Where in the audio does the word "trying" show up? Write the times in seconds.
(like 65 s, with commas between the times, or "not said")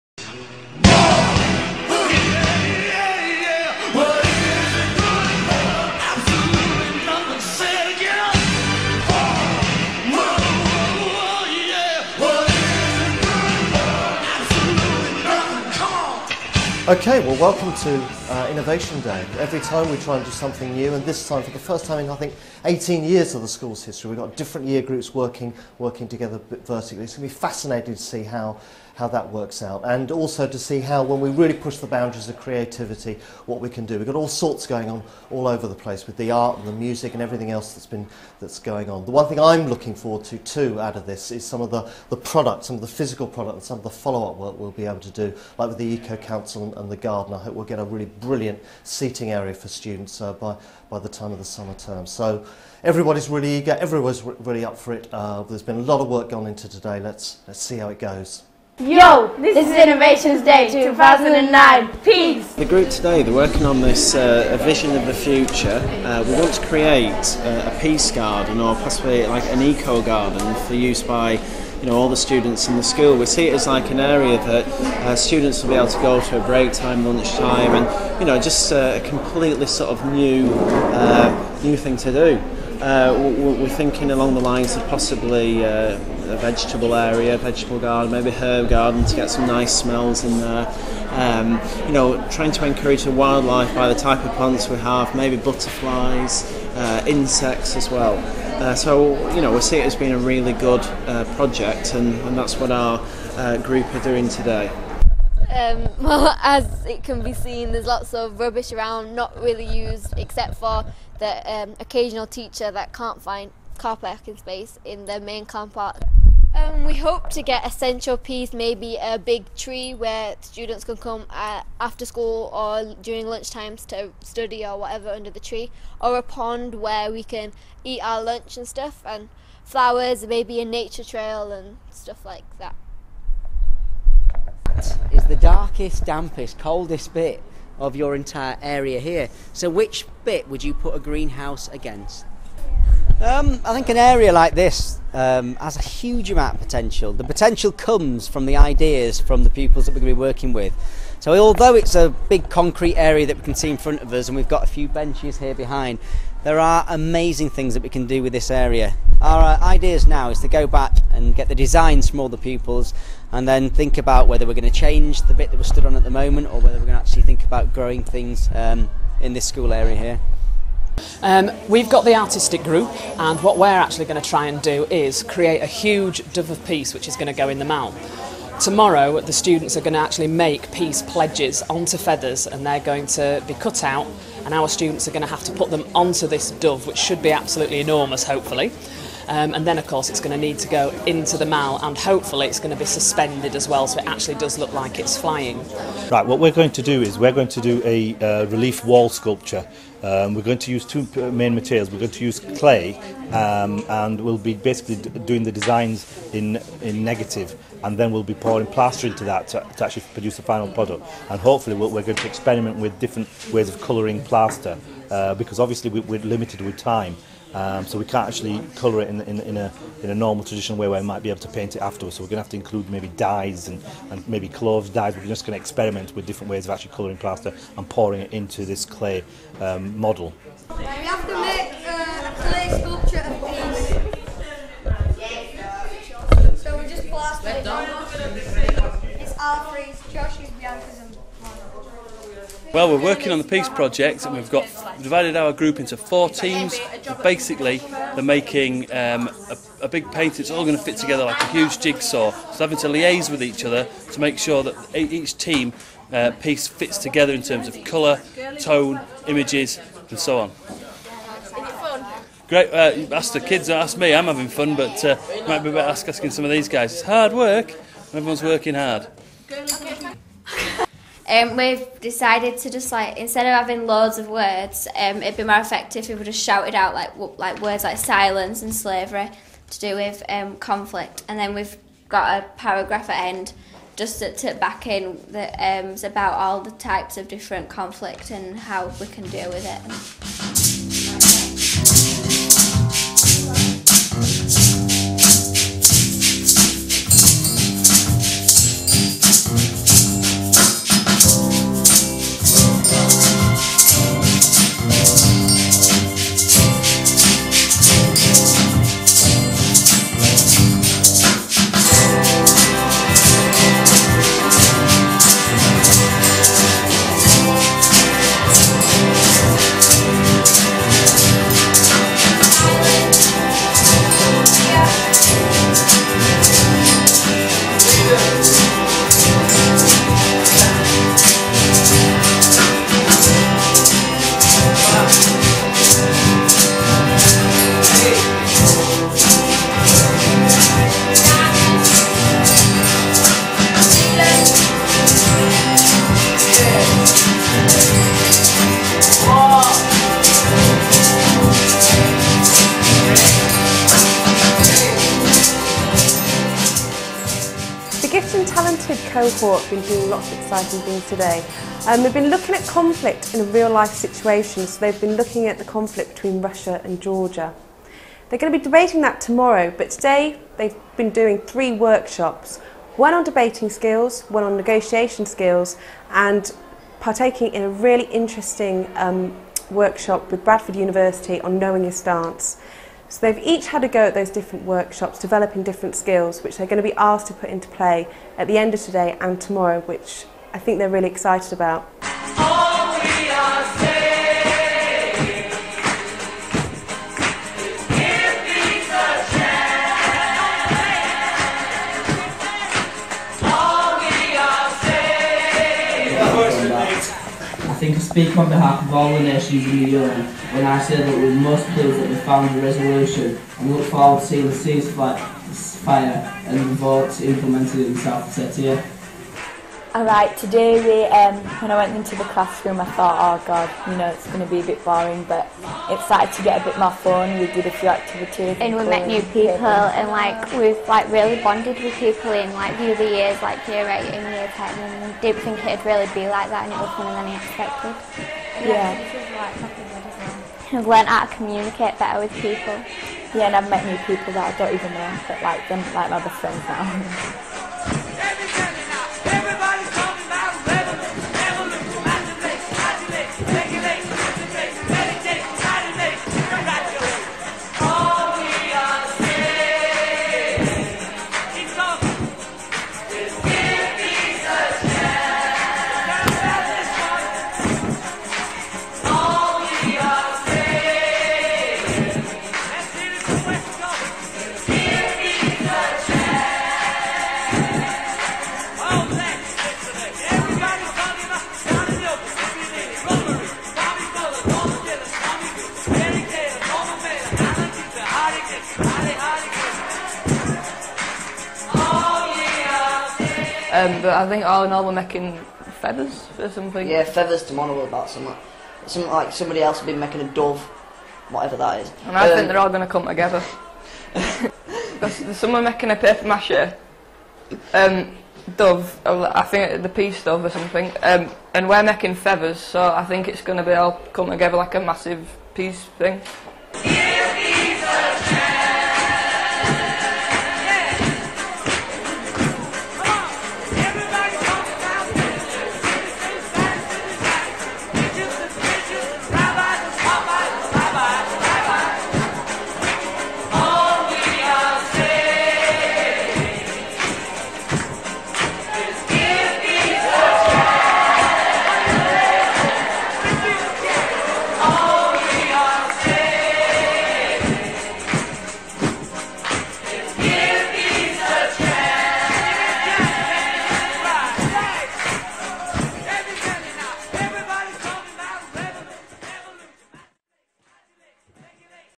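92 s.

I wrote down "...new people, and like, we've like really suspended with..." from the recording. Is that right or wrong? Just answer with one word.
wrong.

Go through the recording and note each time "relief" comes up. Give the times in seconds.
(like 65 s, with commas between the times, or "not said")
198 s.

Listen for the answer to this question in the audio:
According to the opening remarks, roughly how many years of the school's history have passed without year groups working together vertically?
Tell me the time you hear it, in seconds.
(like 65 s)
22 s.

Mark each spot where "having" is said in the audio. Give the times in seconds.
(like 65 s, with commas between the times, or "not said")
252 s, 264 s, 273 s.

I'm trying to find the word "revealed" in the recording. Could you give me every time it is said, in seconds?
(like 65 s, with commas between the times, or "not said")
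not said.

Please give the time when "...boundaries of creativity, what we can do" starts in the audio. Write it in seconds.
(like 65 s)
31 s.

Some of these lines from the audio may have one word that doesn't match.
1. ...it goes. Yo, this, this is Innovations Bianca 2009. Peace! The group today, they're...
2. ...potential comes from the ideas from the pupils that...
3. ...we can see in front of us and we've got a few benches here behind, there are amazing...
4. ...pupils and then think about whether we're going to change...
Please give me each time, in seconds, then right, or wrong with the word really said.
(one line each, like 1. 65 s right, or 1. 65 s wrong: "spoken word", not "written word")
1. 57 s wrong: "Day", not "Bianca"
2. 147 s right
3. 153 s right
4. 162 s right.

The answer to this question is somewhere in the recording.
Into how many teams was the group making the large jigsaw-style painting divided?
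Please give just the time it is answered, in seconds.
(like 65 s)
245 s.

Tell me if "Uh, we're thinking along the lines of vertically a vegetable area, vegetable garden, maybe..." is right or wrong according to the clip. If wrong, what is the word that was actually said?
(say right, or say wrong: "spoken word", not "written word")
wrong: "possibly", not "vertically".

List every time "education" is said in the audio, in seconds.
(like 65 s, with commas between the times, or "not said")
not said.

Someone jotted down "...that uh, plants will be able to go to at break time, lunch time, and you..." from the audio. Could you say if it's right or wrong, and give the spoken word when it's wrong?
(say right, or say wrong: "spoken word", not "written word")
wrong: "students", not "plants".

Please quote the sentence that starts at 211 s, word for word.
And hopefully we'll, we're going to experiment with different ways of colouring plaster uh, because obviously we, we're limited with time.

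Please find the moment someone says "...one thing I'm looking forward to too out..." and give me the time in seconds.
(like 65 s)
39 s.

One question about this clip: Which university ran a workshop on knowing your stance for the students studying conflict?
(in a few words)
Bradford University.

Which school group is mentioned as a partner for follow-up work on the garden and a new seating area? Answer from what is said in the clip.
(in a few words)
Eco Council.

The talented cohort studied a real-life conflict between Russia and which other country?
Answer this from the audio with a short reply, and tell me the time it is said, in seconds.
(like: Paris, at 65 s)
Georgia, at 367 s.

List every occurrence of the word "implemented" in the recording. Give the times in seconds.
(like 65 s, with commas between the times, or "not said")
417 s.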